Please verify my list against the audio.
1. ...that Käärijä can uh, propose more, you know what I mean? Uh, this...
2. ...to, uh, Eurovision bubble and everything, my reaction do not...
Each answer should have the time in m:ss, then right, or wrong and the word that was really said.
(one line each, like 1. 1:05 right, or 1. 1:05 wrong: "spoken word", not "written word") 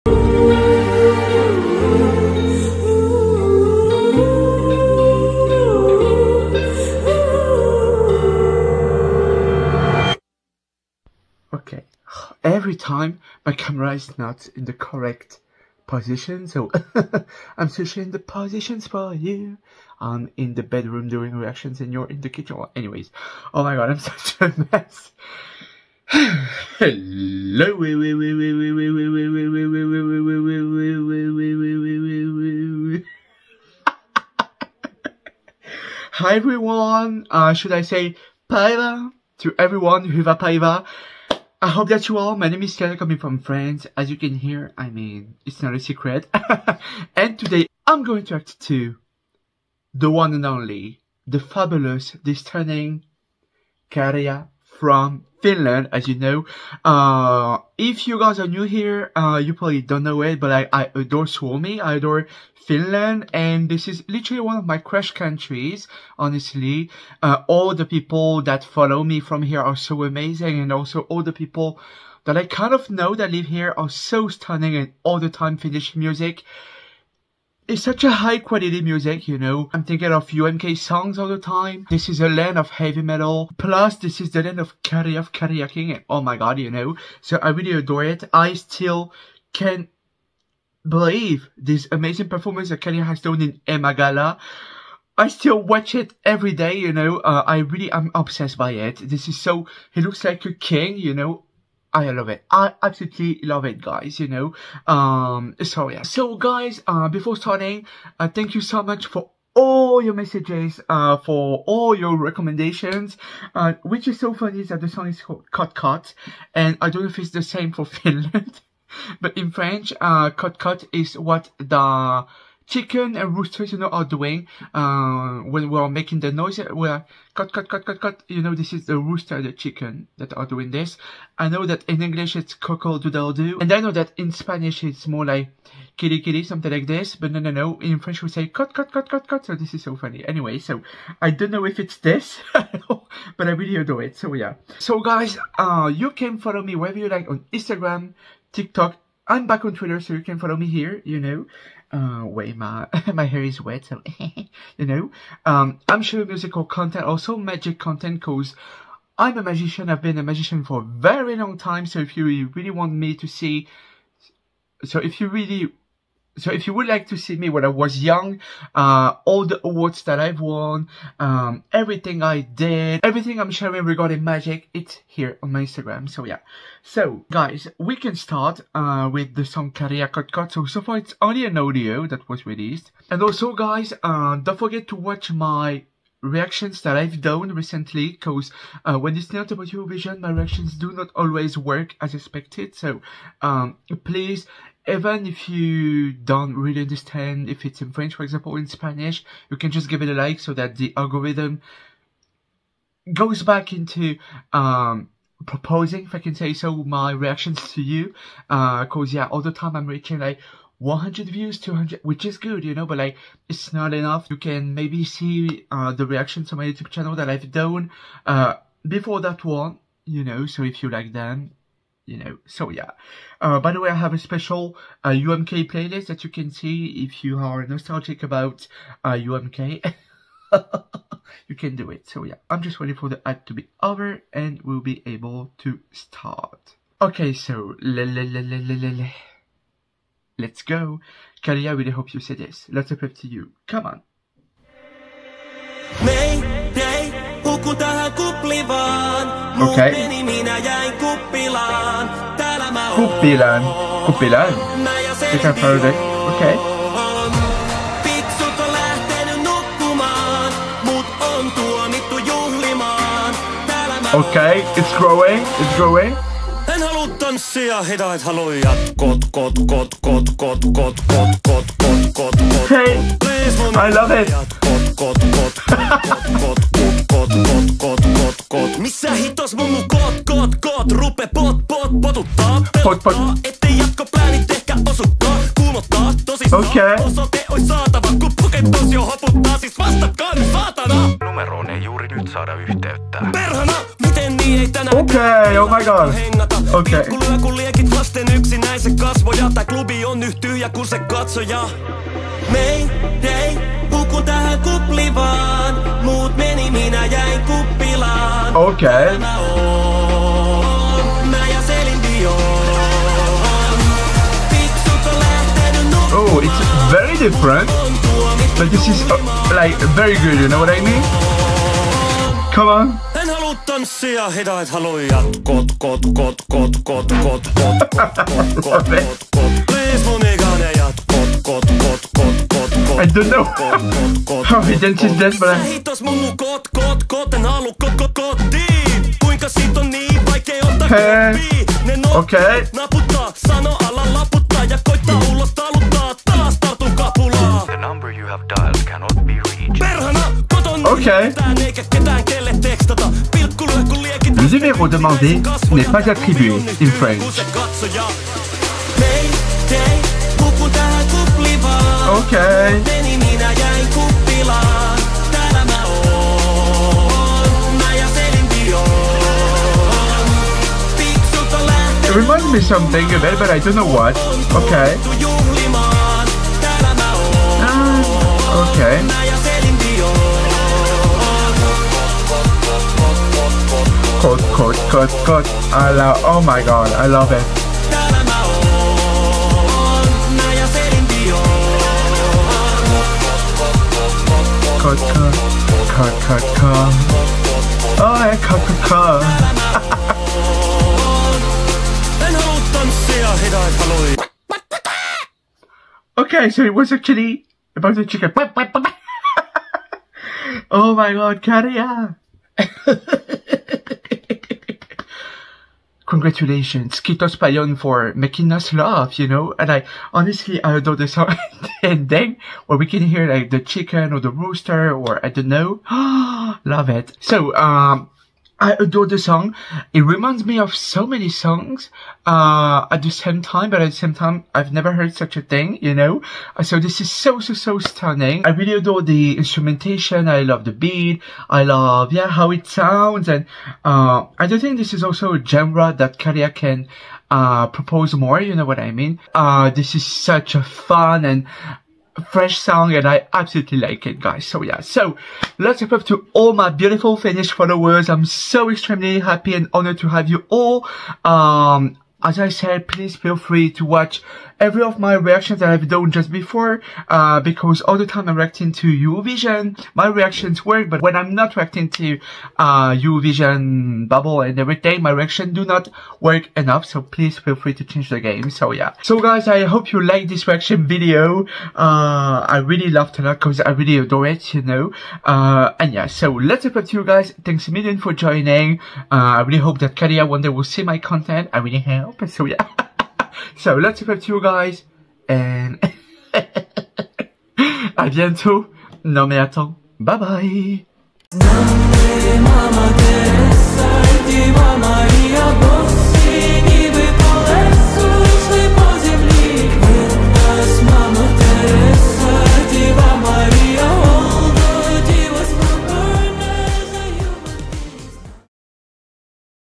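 1. 7:25 right
2. 7:51 right.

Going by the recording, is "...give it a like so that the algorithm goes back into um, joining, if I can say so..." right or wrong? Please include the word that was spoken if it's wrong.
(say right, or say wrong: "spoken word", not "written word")
wrong: "proposing", not "joining".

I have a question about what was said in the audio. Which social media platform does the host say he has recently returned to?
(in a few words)
Twitter.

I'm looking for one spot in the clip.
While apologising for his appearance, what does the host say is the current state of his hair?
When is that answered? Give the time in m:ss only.
2:33.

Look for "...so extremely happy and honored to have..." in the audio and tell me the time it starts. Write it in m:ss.
7:38.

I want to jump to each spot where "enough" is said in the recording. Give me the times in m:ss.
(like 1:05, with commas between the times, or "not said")
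3:33, 7:56.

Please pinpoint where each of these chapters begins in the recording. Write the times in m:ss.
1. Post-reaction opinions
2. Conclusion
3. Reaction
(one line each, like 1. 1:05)
1. 6:46
2. 7:58
3. 3:56.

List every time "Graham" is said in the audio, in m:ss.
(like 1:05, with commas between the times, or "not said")
not said.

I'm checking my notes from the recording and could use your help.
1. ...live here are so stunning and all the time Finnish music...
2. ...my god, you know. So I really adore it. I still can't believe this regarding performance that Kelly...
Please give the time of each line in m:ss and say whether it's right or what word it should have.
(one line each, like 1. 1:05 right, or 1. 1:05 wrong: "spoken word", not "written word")
1. 1:13 right
2. 1:26 wrong: "amazing", not "regarding".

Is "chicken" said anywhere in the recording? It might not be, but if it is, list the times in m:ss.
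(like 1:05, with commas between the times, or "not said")
2:02, 2:09, 6:48, 7:03.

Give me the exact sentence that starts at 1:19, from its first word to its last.
I'm thinking of UMK songs all the time.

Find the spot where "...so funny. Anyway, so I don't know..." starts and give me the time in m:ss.
2:19.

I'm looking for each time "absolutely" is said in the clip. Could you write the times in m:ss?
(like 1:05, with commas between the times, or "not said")
1:42, 7:33.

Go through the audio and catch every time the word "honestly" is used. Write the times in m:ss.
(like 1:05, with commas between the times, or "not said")
1:06, 7:00.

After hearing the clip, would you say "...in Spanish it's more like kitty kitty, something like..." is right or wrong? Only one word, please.
right.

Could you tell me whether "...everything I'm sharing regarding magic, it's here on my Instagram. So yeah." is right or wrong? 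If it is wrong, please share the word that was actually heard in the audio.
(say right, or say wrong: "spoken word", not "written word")
right.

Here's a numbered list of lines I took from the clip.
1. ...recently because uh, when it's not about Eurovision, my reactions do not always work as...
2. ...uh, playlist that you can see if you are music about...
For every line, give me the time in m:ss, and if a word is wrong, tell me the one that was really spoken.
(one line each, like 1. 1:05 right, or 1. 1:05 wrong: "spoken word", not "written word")
1. 3:07 right
2. 3:45 wrong: "nostalgic", not "music".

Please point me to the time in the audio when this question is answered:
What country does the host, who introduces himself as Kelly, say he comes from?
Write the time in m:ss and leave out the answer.
0:43.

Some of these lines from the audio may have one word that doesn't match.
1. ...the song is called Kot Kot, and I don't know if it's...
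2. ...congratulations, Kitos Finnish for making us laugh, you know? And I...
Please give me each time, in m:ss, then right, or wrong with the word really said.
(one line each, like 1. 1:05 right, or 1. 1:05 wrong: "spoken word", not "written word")
1. 1:54 right
2. 6:56 wrong: "Payon", not "Finnish".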